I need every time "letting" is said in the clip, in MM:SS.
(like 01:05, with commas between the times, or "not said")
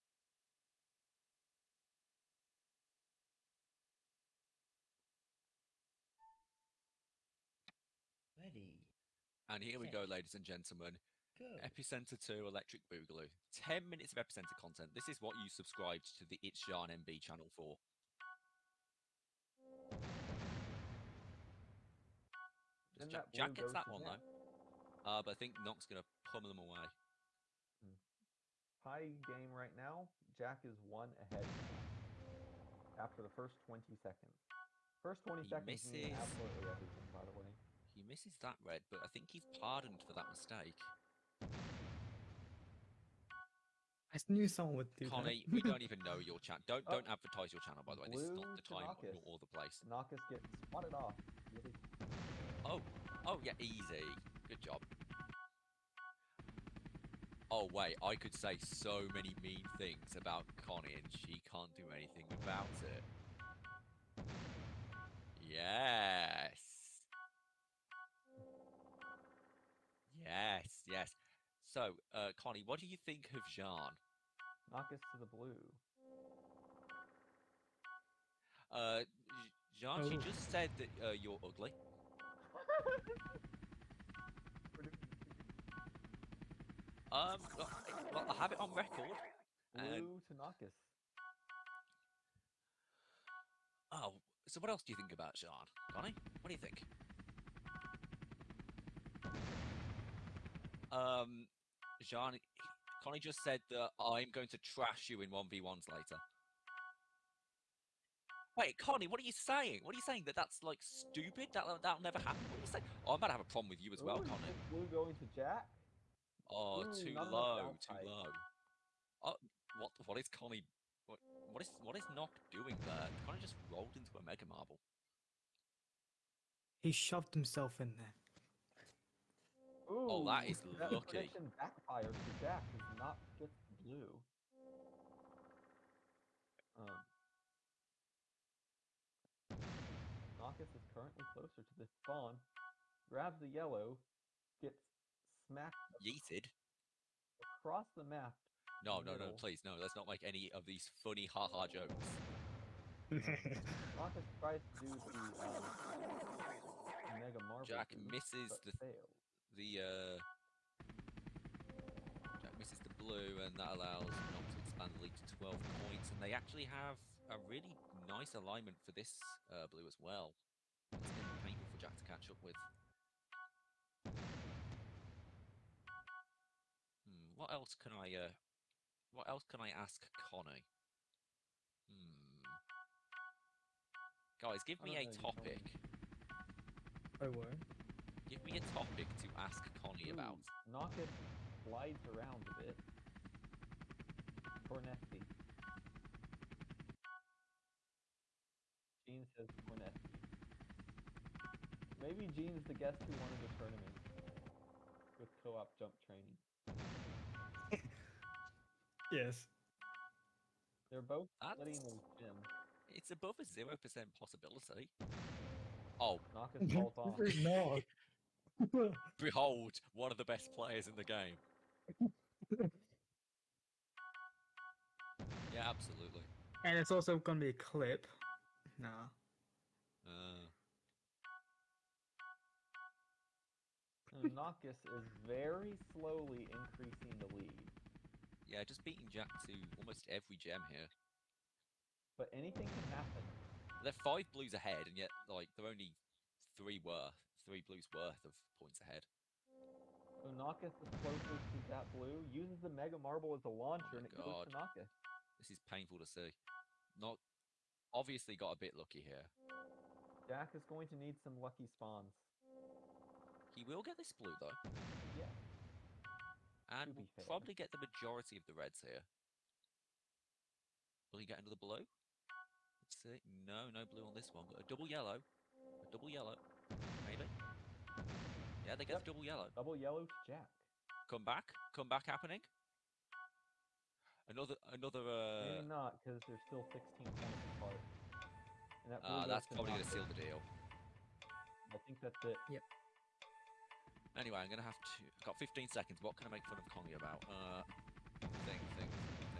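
03:31.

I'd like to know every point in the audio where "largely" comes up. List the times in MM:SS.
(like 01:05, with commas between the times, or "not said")
not said.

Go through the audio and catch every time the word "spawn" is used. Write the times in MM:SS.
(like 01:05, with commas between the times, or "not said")
02:21, 04:21.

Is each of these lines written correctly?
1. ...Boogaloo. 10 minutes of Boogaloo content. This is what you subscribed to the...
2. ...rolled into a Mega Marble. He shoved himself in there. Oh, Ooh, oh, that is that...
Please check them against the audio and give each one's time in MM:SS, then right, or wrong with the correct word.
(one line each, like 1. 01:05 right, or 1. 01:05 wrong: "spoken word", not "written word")
1. 00:12 wrong: "Epicenter", not "Boogaloo"
2. 02:03 right.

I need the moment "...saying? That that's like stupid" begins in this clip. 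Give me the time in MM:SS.
01:50.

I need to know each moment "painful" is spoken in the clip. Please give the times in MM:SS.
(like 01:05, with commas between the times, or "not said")
02:51, 04:15.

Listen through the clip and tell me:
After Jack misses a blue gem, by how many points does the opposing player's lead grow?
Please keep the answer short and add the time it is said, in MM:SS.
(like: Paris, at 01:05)
12, at 02:45.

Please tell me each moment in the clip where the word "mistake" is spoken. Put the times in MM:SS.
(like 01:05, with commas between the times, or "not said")
00:40.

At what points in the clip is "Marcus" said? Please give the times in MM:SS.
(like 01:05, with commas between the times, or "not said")
02:20, 02:33.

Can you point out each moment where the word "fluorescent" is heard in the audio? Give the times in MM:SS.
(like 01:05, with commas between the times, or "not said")
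not said.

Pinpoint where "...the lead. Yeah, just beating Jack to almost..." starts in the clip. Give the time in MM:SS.
03:57.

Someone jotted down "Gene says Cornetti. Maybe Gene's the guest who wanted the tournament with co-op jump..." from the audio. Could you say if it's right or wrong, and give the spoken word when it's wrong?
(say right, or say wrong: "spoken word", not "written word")
right.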